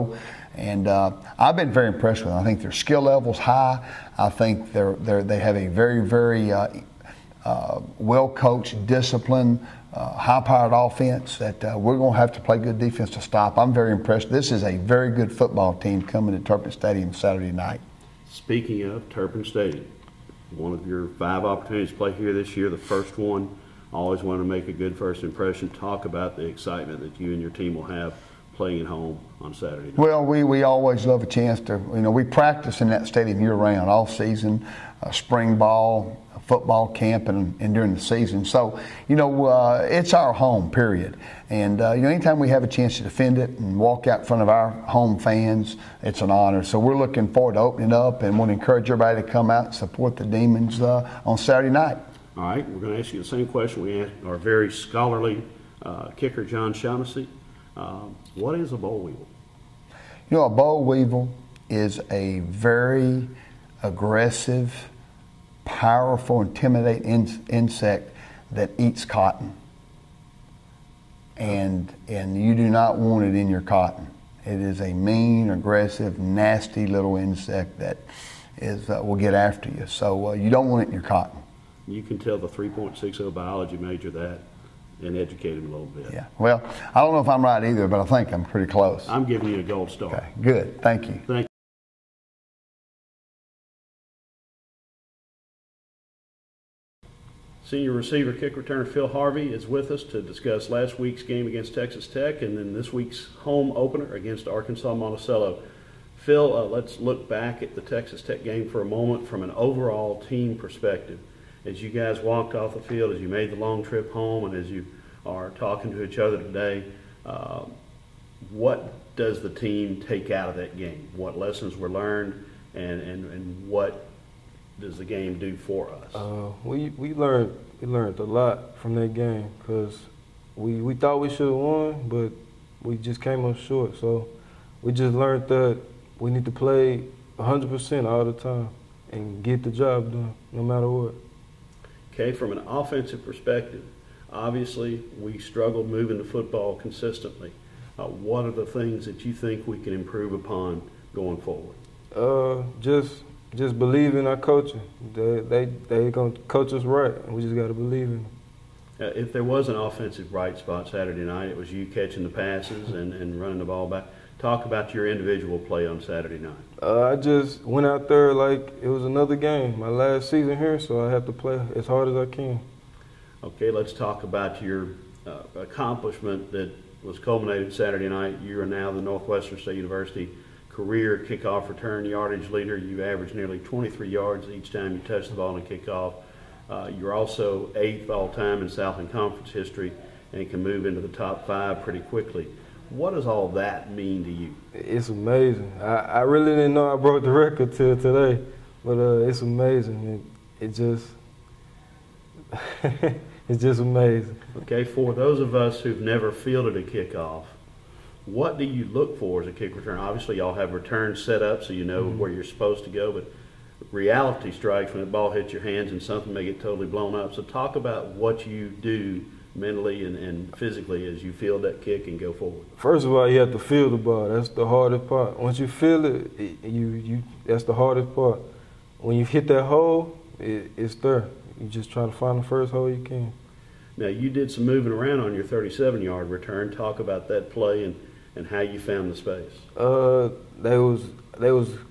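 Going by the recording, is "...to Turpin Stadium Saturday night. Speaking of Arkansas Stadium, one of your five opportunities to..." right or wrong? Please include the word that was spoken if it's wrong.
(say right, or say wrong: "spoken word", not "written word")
wrong: "Turpin", not "Arkansas".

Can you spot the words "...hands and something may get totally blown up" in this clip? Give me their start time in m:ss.
3:35.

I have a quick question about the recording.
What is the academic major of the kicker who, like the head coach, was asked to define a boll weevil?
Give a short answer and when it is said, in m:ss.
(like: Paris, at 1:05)
biology, at 1:23.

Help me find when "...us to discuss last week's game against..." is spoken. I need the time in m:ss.
1:39.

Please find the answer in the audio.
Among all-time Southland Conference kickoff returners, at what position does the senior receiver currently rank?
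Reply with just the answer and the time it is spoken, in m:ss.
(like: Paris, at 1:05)
8th, at 3:07.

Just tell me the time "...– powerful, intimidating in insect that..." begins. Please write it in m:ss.
1:04.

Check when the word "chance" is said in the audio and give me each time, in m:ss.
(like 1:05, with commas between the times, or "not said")
0:31, 0:42.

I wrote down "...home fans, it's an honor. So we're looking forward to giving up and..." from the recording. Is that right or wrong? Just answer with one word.
wrong.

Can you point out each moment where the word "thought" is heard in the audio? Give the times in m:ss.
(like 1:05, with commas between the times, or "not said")
2:10.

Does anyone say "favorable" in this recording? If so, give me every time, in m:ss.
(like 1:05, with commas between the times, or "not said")
not said.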